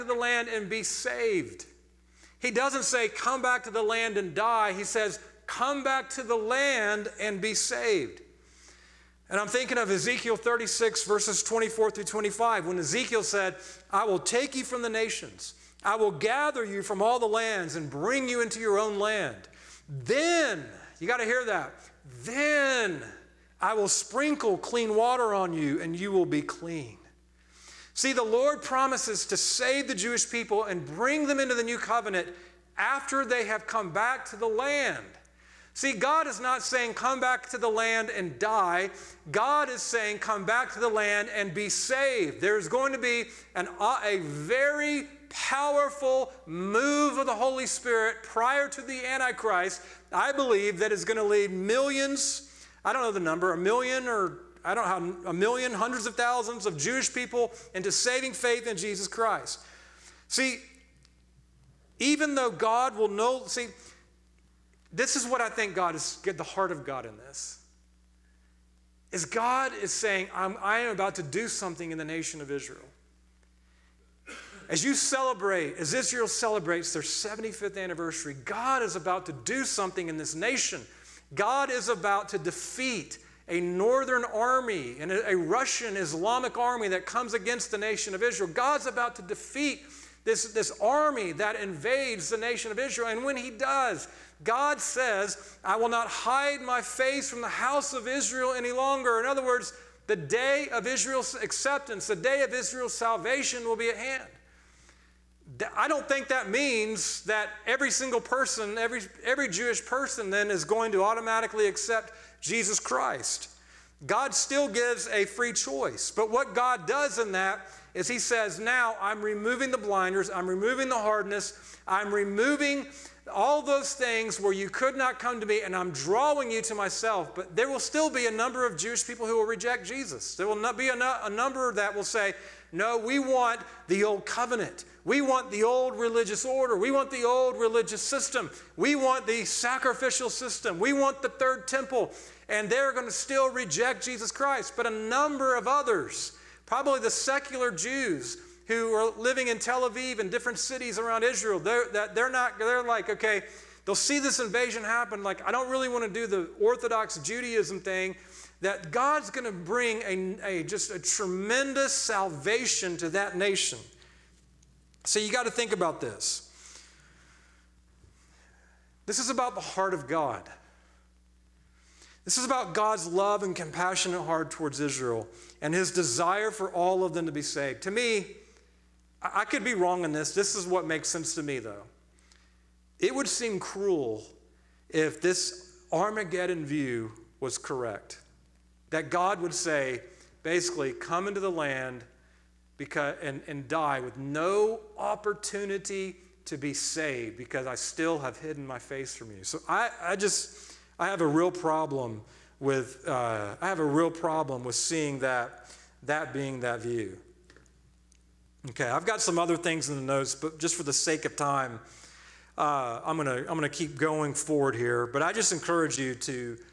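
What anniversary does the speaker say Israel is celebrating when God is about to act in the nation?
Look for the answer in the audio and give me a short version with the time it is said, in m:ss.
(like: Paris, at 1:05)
75th, at 1:17.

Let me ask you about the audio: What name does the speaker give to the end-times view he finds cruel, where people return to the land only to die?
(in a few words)
Armageddon view.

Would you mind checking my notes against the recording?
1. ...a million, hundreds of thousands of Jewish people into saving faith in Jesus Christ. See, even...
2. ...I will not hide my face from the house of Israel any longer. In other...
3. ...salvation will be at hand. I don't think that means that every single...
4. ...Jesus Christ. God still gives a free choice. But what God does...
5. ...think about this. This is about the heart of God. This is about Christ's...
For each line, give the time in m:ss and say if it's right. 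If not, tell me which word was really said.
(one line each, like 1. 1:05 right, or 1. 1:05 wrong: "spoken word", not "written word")
1. 0:55 right
2. 1:35 right
3. 1:42 right
4. 1:52 right
5. 2:45 wrong: "God", not "Christ".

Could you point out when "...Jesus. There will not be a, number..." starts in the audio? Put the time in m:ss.
2:09.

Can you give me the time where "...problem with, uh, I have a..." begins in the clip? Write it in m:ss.
3:21.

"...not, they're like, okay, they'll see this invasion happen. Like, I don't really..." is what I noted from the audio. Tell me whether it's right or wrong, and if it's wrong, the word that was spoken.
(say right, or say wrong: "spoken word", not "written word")
right.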